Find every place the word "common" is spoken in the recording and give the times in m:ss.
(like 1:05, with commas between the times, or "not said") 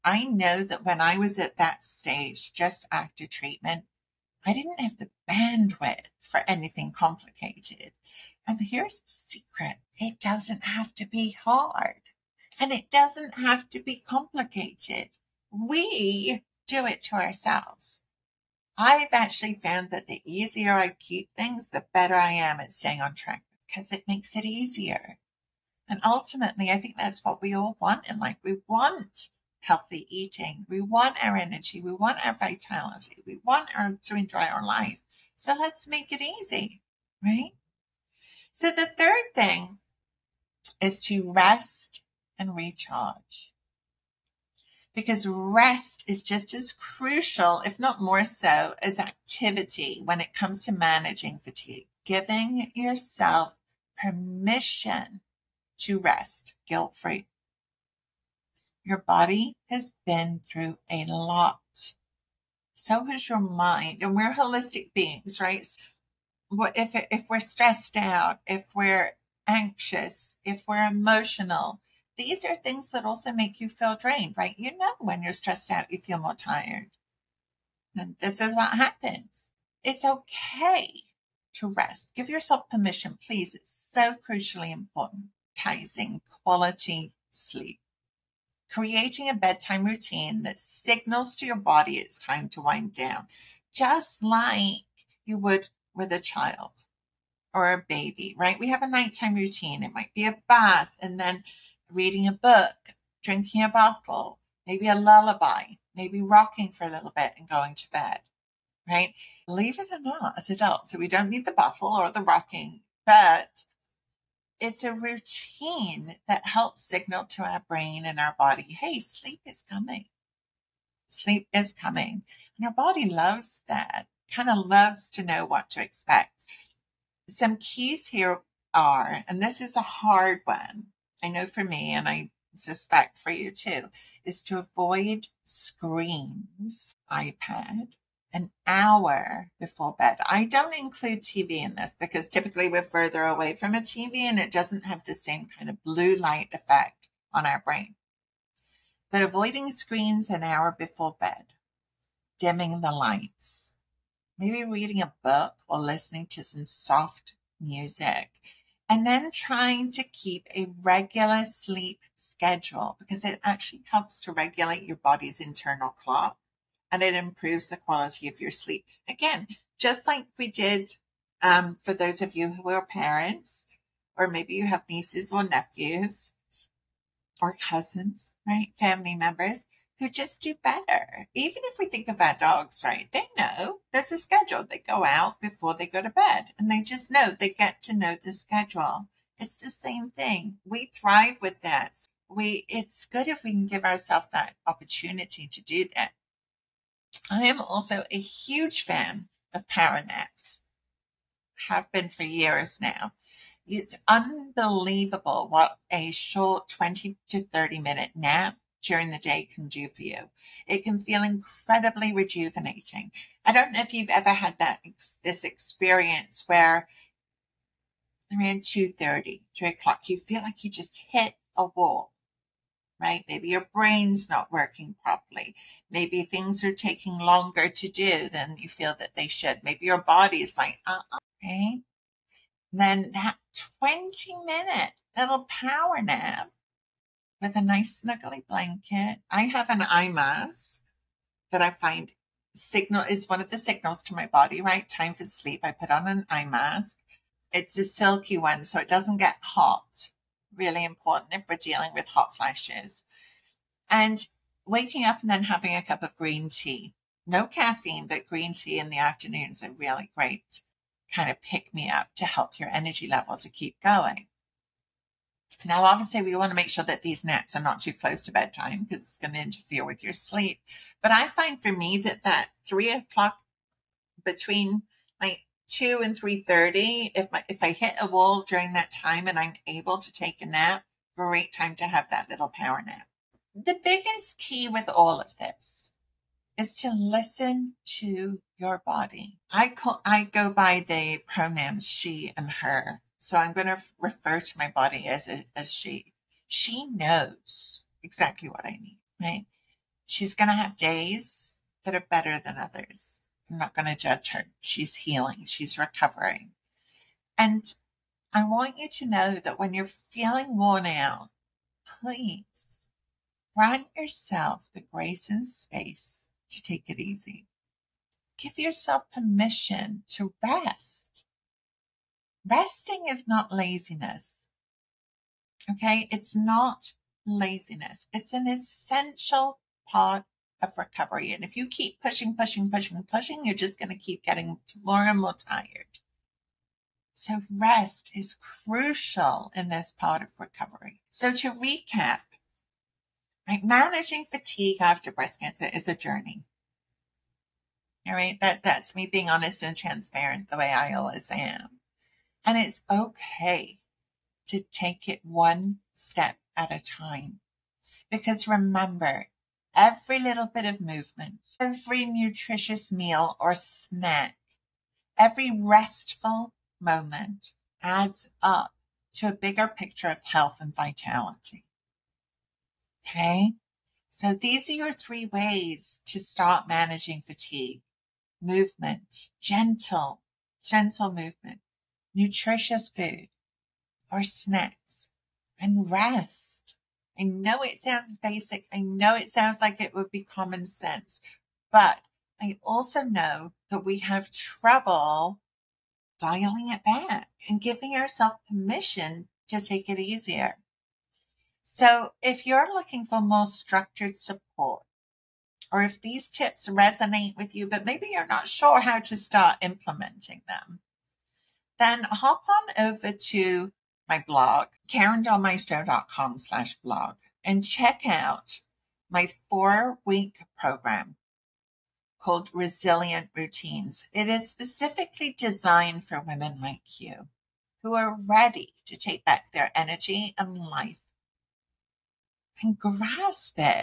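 6:30.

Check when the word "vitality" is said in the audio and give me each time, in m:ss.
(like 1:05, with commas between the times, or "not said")
0:32, 6:10.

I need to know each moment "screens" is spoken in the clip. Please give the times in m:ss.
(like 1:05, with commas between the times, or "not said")
2:15, 2:29.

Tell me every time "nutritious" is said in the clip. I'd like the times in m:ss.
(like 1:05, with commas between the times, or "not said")
6:02, 6:22.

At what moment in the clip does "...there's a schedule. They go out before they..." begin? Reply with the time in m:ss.
3:03.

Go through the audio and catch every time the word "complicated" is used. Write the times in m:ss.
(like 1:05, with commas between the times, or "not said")
0:06, 0:14.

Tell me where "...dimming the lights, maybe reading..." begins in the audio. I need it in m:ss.
2:32.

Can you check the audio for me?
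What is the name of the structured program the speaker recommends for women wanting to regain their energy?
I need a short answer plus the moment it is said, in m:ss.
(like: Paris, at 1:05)
Resilient Routines, at 7:02.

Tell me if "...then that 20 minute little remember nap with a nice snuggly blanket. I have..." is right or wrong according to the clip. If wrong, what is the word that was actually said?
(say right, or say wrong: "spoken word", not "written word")
wrong: "power", not "remember".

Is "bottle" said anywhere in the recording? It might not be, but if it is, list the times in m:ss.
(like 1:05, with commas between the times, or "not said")
1:43, 1:51.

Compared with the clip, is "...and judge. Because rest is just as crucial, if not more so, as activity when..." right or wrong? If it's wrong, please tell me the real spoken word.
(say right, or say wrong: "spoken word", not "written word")
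wrong: "recharge", not "judge".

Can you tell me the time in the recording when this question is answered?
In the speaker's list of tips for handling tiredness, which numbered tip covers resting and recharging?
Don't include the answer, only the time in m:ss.
0:38.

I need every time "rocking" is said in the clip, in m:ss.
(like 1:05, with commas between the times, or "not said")
1:46, 1:52.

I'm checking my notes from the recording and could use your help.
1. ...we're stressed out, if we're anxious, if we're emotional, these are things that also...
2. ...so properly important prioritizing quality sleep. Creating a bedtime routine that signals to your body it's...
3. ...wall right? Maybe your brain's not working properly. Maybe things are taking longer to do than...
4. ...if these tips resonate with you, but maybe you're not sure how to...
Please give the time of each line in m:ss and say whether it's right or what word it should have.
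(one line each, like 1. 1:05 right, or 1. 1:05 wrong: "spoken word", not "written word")
1. 1:07 right
2. 1:23 wrong: "crucially", not "properly"
3. 3:41 right
4. 6:45 right.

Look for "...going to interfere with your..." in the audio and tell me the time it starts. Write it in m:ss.
4:29.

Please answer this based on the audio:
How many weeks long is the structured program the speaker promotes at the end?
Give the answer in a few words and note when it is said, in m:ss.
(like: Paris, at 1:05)
4, at 6:59.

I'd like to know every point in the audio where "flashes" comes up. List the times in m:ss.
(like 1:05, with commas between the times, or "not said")
4:12.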